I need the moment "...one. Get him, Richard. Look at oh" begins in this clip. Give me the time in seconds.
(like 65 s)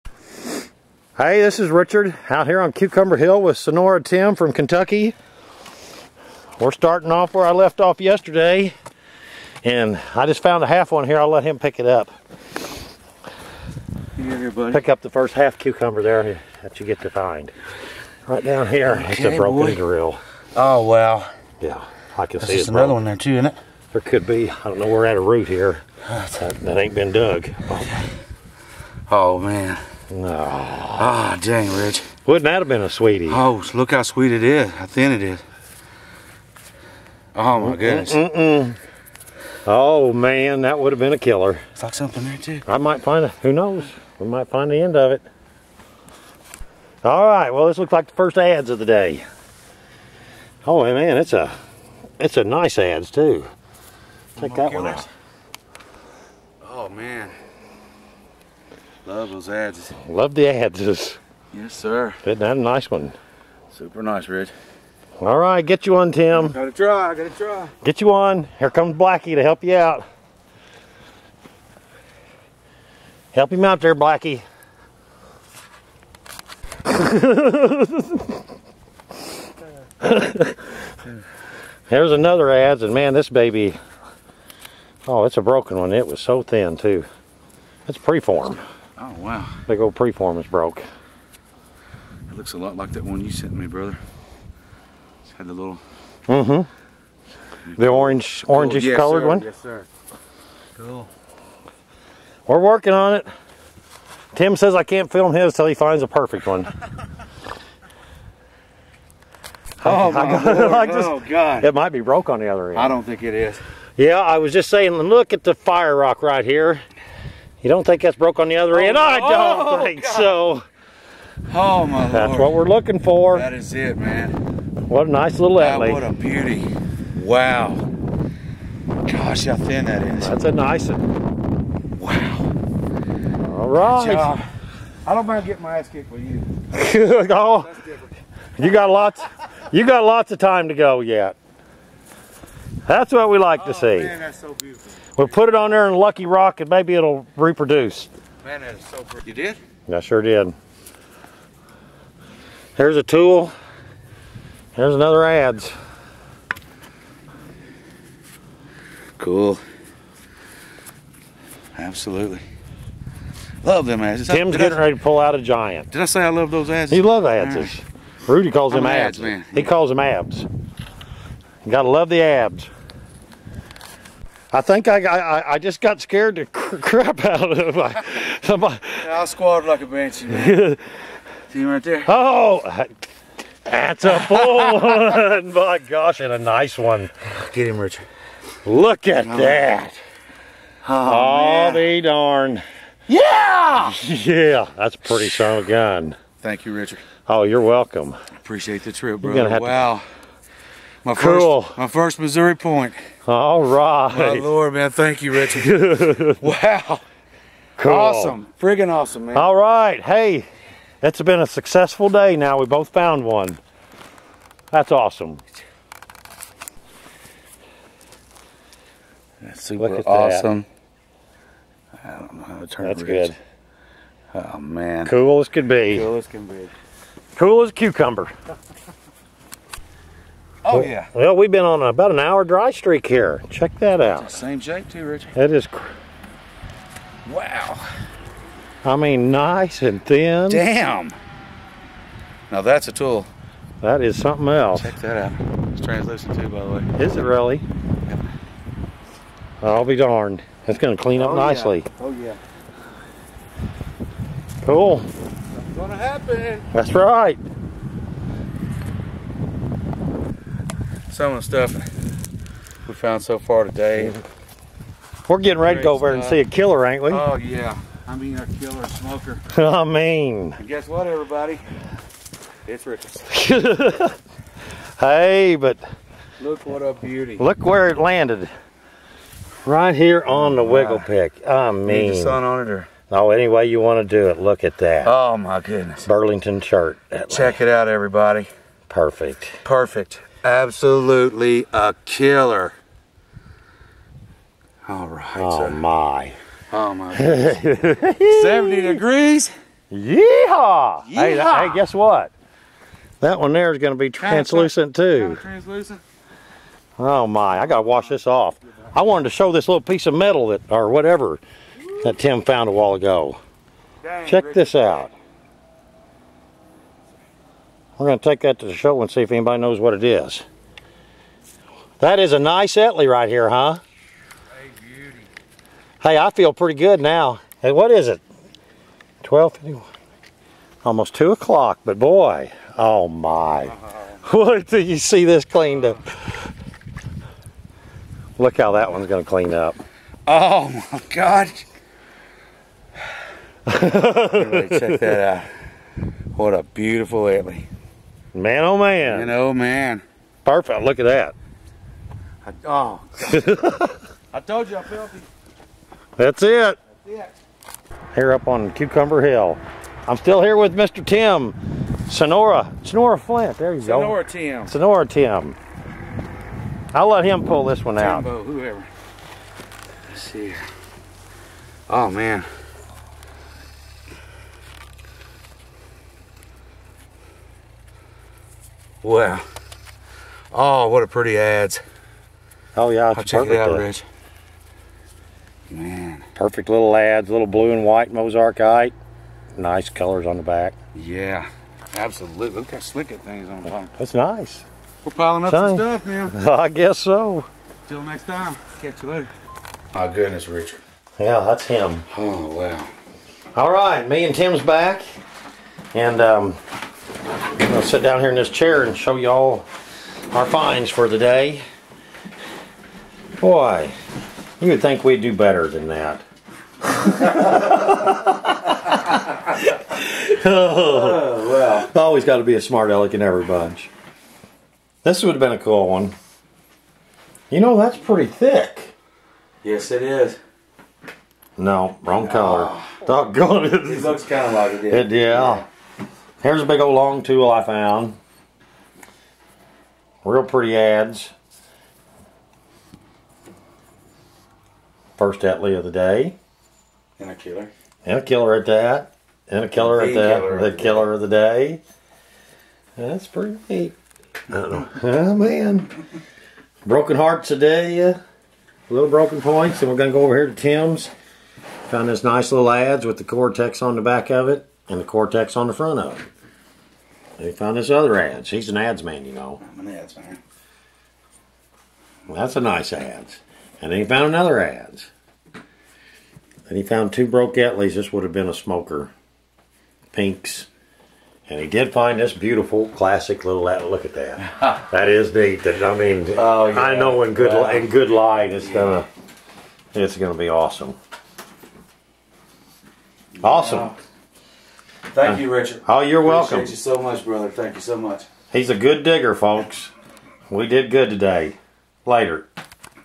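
186 s.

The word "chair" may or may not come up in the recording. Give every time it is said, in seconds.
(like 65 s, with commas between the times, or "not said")
408 s.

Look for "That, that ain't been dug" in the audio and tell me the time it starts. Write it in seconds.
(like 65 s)
26 s.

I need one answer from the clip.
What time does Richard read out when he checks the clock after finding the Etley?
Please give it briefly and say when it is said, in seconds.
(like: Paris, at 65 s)
12:51, at 329 s.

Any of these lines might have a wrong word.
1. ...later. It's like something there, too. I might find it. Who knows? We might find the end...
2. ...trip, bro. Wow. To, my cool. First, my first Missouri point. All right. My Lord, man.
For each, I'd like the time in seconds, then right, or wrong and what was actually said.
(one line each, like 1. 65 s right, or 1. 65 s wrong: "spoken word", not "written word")
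1. 41 s wrong: "killer", not "later"
2. 198 s right.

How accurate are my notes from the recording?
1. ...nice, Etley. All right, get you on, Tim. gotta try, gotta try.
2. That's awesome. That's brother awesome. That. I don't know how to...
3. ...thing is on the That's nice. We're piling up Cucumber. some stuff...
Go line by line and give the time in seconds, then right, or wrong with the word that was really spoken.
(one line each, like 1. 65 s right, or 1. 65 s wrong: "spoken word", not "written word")
1. 64 s wrong: "Rich", not "Etley"
2. 214 s wrong: "super", not "brother"
3. 393 s wrong: "Same", not "Cucumber".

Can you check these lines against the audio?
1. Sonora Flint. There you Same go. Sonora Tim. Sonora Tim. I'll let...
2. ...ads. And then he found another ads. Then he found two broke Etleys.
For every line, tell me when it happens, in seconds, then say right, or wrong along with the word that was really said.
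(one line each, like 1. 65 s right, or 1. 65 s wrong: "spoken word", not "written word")
1. 362 s wrong: "Sonora", not "Same"
2. 472 s right.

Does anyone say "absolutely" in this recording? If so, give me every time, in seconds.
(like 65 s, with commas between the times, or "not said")
161 s, 290 s, 391 s.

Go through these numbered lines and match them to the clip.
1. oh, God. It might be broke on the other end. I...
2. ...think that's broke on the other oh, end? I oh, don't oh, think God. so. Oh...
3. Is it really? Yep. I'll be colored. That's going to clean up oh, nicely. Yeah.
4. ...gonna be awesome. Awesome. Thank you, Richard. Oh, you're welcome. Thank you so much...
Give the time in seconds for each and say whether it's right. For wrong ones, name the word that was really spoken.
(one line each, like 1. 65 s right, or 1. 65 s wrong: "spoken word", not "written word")
1. 111 s right
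2. 117 s right
3. 247 s wrong: "darned", not "colored"
4. 490 s right.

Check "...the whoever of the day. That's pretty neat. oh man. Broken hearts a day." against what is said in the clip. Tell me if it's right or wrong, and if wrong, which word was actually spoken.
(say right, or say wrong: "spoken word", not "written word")
wrong: "killer", not "whoever".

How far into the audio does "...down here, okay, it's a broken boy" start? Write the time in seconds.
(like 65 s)
18 s.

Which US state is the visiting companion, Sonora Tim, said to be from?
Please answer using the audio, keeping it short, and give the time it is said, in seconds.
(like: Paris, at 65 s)
Kentucky, at 4 s.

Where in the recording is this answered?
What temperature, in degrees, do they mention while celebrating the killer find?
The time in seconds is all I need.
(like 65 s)
297 s.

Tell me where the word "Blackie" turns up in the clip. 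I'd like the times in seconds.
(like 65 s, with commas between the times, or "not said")
68 s, 73 s.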